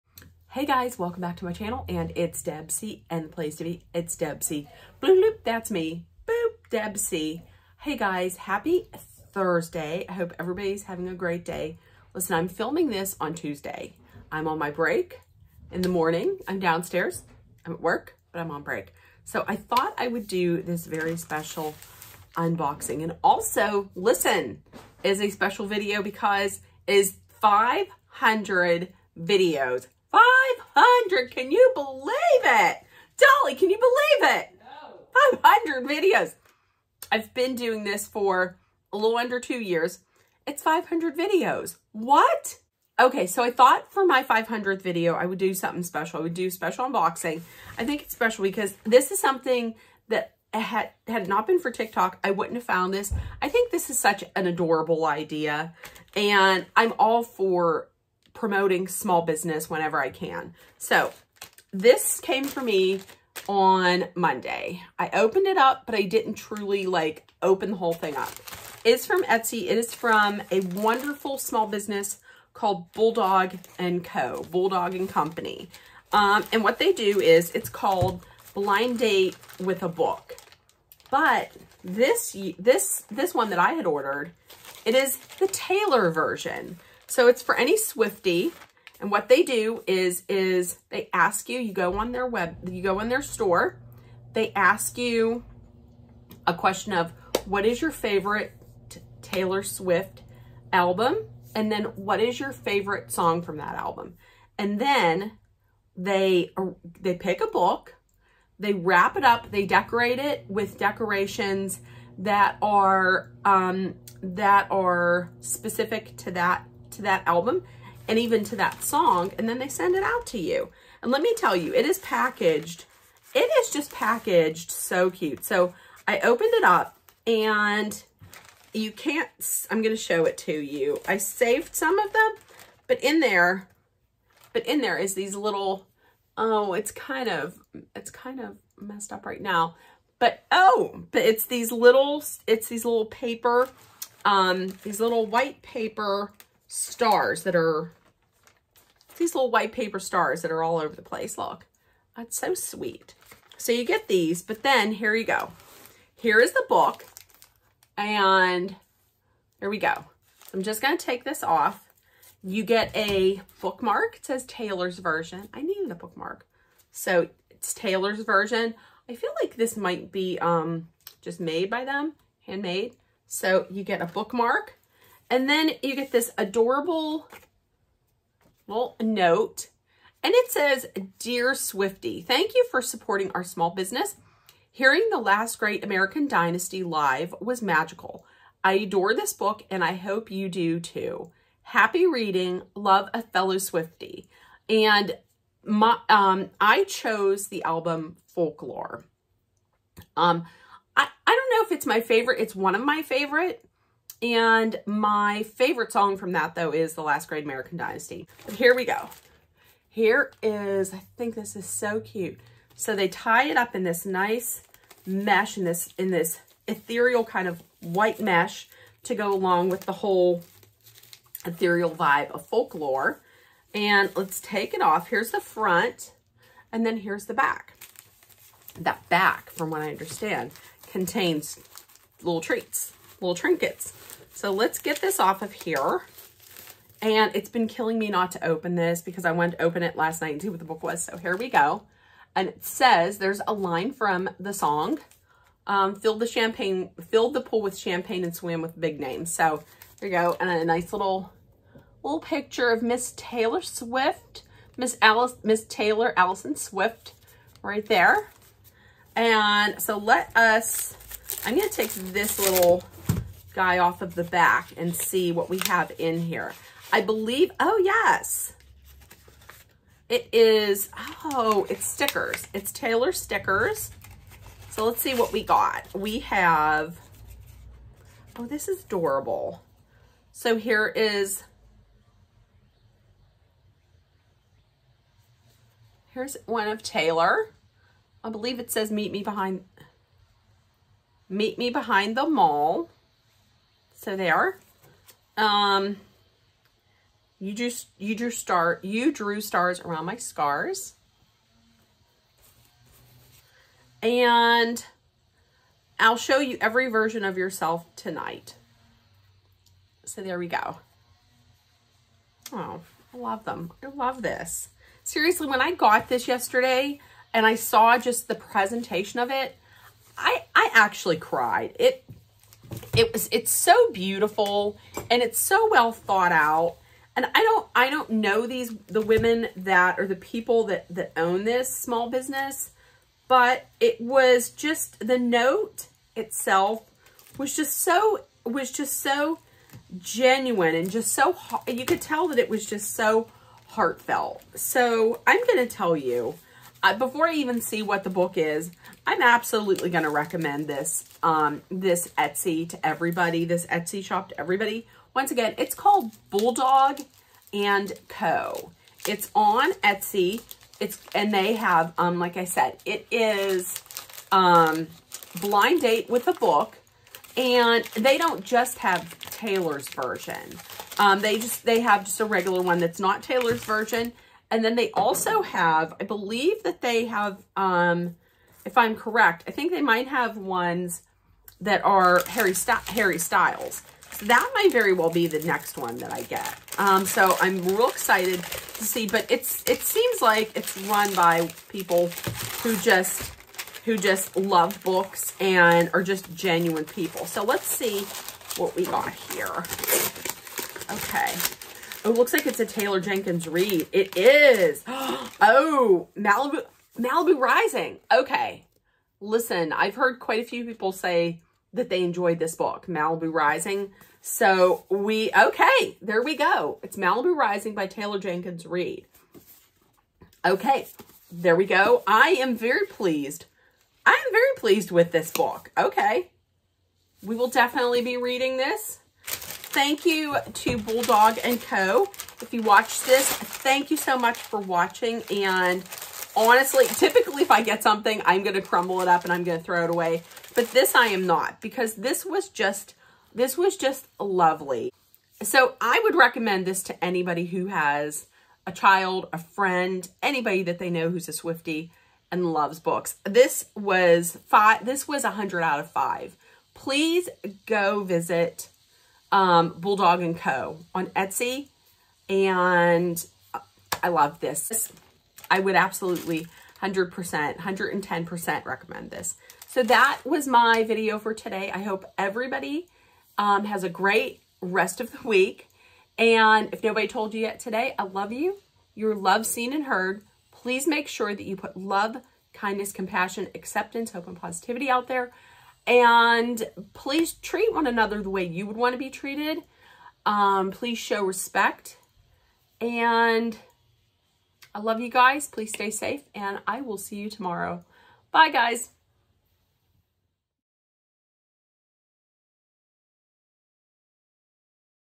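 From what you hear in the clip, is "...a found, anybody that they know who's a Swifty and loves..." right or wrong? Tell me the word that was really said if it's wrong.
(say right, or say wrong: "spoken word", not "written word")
wrong: "friend", not "found".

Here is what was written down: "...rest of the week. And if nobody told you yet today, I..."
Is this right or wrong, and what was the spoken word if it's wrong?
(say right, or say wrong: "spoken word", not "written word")
right.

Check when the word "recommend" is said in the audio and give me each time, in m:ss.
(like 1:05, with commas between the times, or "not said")
5:50, 7:26, 7:48.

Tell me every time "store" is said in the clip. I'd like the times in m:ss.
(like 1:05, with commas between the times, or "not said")
1:33.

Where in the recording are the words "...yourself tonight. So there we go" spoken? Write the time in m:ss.
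5:07.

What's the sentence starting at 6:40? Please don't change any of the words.
Okay it looks like it's a Taylor Jenkins Reid.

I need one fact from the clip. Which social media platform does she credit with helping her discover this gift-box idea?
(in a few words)
TikTok.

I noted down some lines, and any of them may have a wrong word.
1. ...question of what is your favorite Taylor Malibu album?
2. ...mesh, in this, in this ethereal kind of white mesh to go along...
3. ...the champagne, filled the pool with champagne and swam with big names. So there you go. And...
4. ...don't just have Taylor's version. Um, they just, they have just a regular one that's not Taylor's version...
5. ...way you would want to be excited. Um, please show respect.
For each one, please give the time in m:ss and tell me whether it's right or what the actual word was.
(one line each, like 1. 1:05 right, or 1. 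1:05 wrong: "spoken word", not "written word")
1. 1:36 wrong: "Swift", not "Malibu"
2. 3:35 right
3. 4:06 right
4. 6:08 right
5. 8:08 wrong: "treated", not "excited".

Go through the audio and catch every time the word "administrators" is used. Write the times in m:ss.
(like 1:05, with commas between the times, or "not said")
not said.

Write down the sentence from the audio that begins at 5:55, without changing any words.
Once again, it's called Bulldog and Co.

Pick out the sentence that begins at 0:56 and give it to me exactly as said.
And I'm all for promoting small business whenever I can.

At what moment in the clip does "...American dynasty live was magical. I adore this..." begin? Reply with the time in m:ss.
3:05.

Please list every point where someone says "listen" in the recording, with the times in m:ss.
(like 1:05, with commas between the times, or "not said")
0:12, 0:23, 6:49.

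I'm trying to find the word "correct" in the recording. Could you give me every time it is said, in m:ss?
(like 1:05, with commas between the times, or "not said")
6:18.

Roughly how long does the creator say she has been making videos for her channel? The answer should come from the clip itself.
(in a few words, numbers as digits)
a little under two years.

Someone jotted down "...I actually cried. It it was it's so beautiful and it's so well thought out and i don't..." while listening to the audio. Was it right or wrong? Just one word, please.
right.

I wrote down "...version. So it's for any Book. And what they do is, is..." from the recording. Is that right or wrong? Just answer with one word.
wrong.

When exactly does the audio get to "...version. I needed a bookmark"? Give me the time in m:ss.
2:44.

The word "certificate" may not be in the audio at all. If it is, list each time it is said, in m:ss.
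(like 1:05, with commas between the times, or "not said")
not said.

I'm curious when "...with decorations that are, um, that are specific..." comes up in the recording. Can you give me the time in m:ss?
1:50.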